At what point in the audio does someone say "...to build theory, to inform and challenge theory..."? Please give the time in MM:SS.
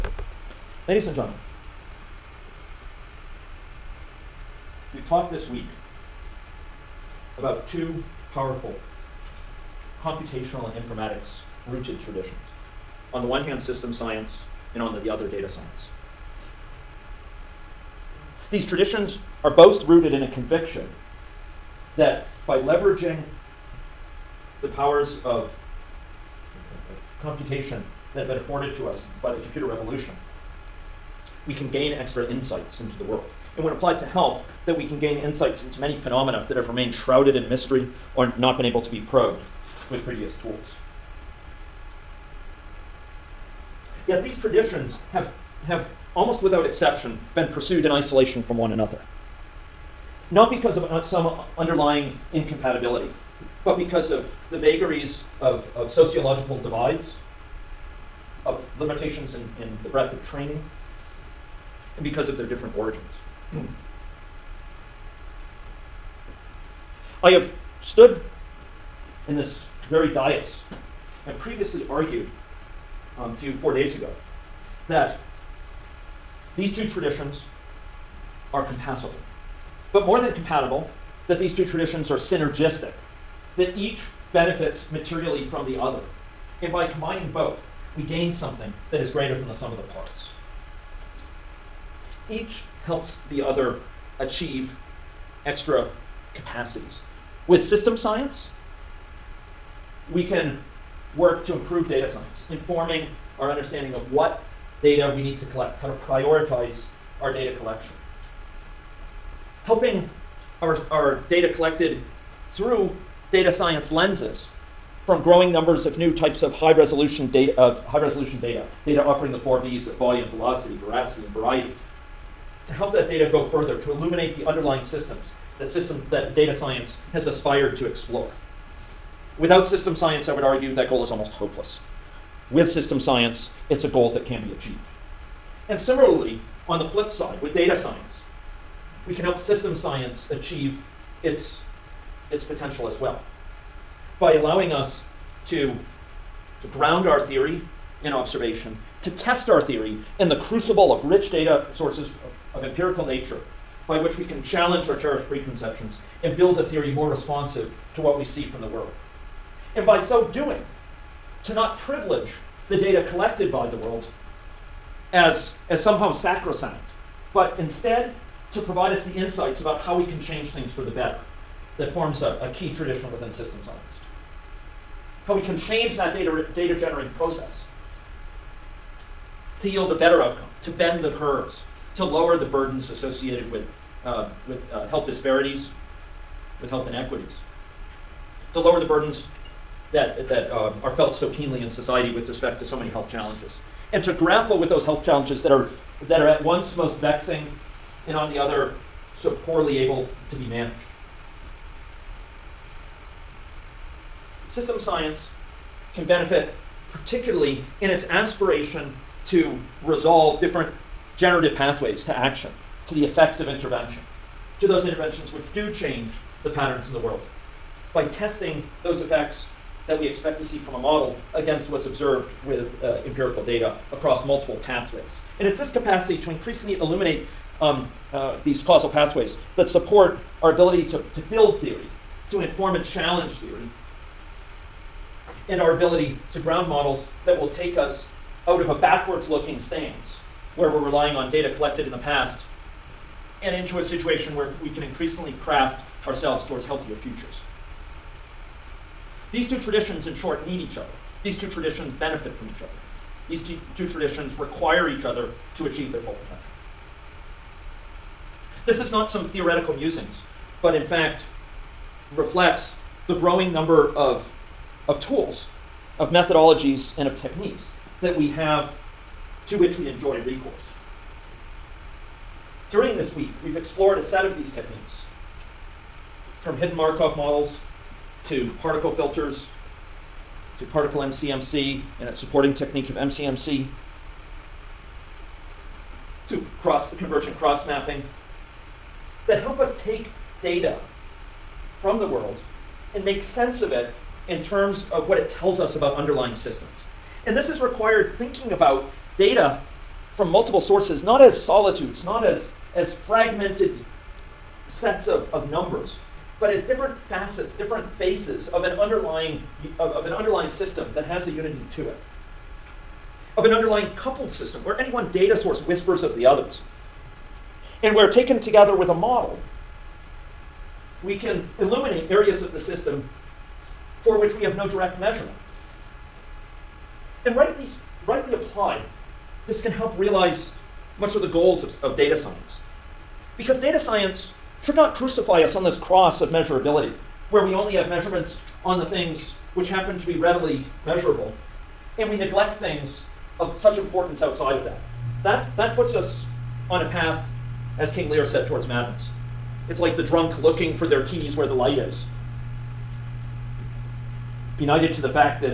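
03:51.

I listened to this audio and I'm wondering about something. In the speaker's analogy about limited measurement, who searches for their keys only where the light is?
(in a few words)
The drunk.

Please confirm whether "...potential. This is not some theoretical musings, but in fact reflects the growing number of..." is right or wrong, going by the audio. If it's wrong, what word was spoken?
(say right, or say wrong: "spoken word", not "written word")
right.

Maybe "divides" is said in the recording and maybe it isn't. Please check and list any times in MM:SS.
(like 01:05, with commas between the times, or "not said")
00:56.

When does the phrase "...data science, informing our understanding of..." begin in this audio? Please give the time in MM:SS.
01:41.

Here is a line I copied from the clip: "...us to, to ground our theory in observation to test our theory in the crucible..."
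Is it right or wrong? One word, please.
right.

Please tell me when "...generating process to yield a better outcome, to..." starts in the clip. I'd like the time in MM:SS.
02:56.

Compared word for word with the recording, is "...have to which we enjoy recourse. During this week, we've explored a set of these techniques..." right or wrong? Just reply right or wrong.
right.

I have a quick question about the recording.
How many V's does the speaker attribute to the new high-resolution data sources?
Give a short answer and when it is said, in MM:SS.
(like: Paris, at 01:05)
4, at 01:59.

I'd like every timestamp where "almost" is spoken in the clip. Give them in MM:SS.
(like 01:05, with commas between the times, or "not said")
00:46, 02:11.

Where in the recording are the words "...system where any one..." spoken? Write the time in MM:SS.
05:14.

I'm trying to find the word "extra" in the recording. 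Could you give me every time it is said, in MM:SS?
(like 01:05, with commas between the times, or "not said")
00:31, 01:35.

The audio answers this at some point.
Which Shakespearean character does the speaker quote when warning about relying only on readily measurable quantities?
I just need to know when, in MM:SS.
05:47.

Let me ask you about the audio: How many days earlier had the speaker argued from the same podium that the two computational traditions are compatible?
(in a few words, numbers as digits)
4.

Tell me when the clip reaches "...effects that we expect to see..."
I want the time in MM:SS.
03:39.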